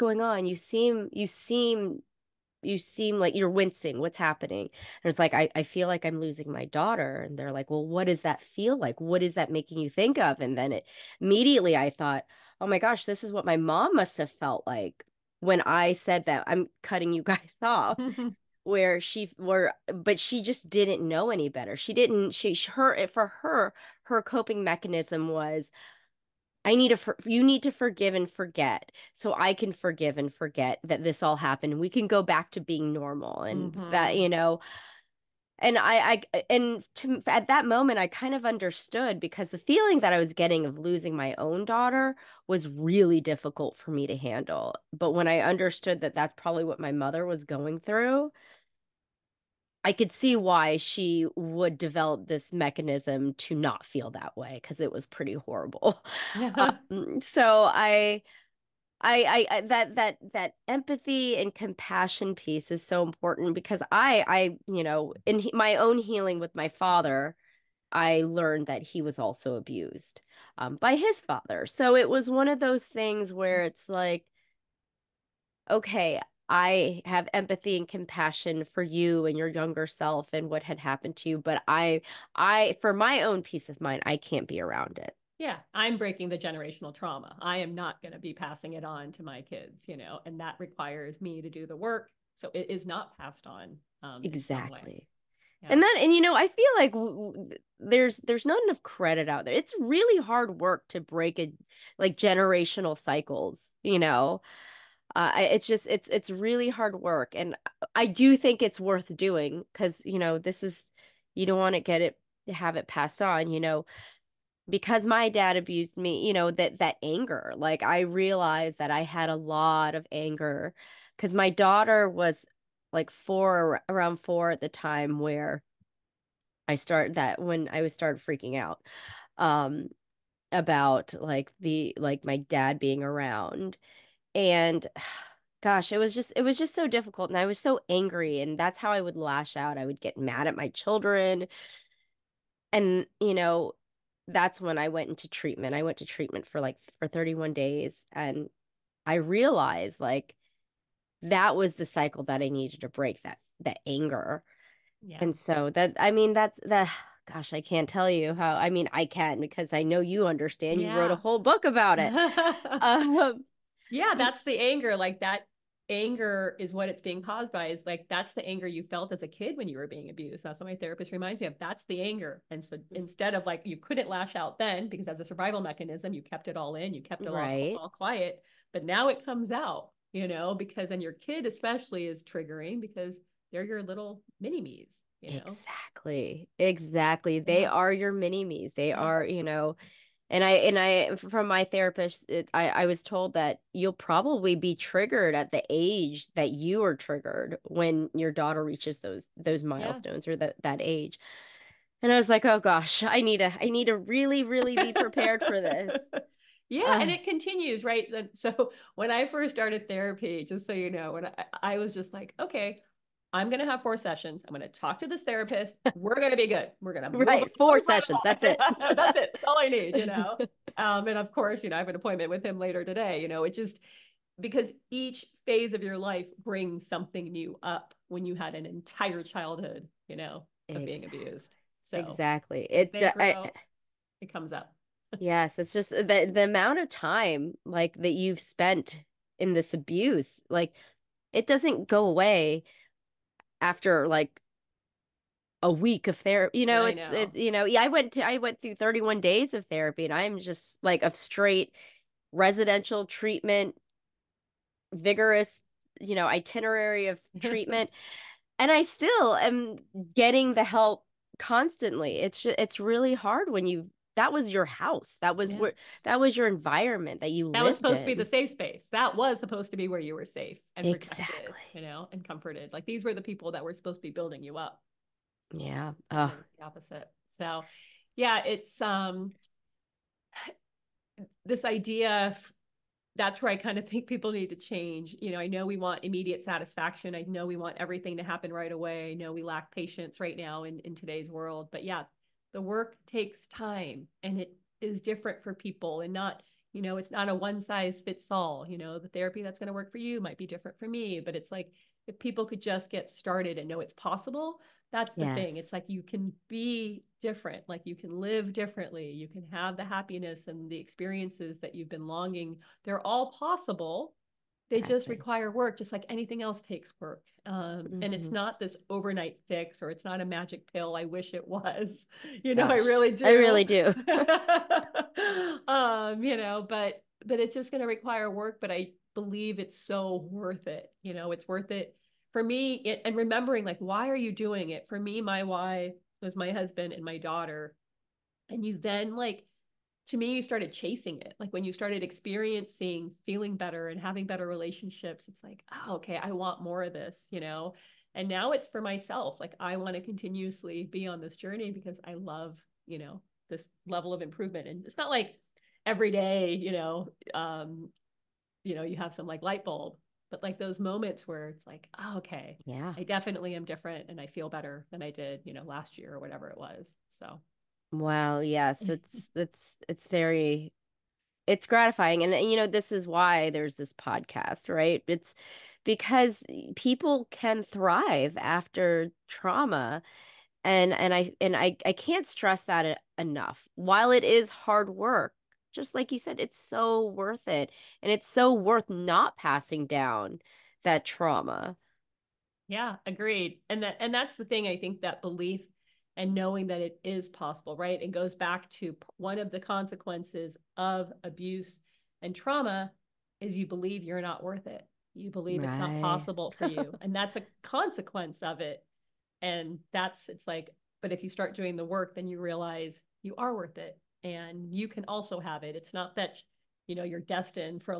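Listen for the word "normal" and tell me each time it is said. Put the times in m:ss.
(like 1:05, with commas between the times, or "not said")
0:32.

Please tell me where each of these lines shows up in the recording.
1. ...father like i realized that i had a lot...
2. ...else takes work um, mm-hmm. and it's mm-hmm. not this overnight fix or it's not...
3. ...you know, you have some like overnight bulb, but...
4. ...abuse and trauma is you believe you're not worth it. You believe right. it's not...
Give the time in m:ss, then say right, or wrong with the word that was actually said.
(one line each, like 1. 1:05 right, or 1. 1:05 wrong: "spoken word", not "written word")
1. 1:57 wrong: "anger", not "father"
2. 5:16 right
3. 5:58 wrong: "light", not "overnight"
4. 6:41 right.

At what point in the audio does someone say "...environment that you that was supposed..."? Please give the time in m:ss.
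4:26.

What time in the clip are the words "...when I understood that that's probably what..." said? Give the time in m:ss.
0:45.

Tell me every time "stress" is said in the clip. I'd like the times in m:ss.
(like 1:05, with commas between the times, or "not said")
6:22.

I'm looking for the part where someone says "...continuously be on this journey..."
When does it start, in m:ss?
5:50.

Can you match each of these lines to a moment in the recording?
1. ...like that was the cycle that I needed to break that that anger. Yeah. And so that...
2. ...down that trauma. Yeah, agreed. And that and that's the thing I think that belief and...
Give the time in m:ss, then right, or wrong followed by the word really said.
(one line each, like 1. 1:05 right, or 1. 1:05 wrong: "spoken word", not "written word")
1. 2:30 right
2. 6:29 right.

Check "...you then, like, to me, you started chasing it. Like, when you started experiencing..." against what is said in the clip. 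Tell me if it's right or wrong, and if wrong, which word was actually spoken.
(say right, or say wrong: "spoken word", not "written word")
right.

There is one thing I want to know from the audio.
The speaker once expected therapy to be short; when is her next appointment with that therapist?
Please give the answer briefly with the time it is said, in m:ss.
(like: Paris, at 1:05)
later today, at 3:42.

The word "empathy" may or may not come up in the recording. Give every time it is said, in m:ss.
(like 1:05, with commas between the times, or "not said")
1:00, 1:17.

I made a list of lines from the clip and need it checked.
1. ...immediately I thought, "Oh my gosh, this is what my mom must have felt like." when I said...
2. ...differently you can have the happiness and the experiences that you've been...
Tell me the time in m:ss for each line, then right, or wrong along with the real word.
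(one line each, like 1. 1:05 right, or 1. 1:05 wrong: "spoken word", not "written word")
1. 0:11 right
2. 5:08 right.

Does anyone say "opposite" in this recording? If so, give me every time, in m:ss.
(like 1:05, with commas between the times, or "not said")
4:36.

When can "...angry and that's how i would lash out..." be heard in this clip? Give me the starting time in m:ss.
2:17.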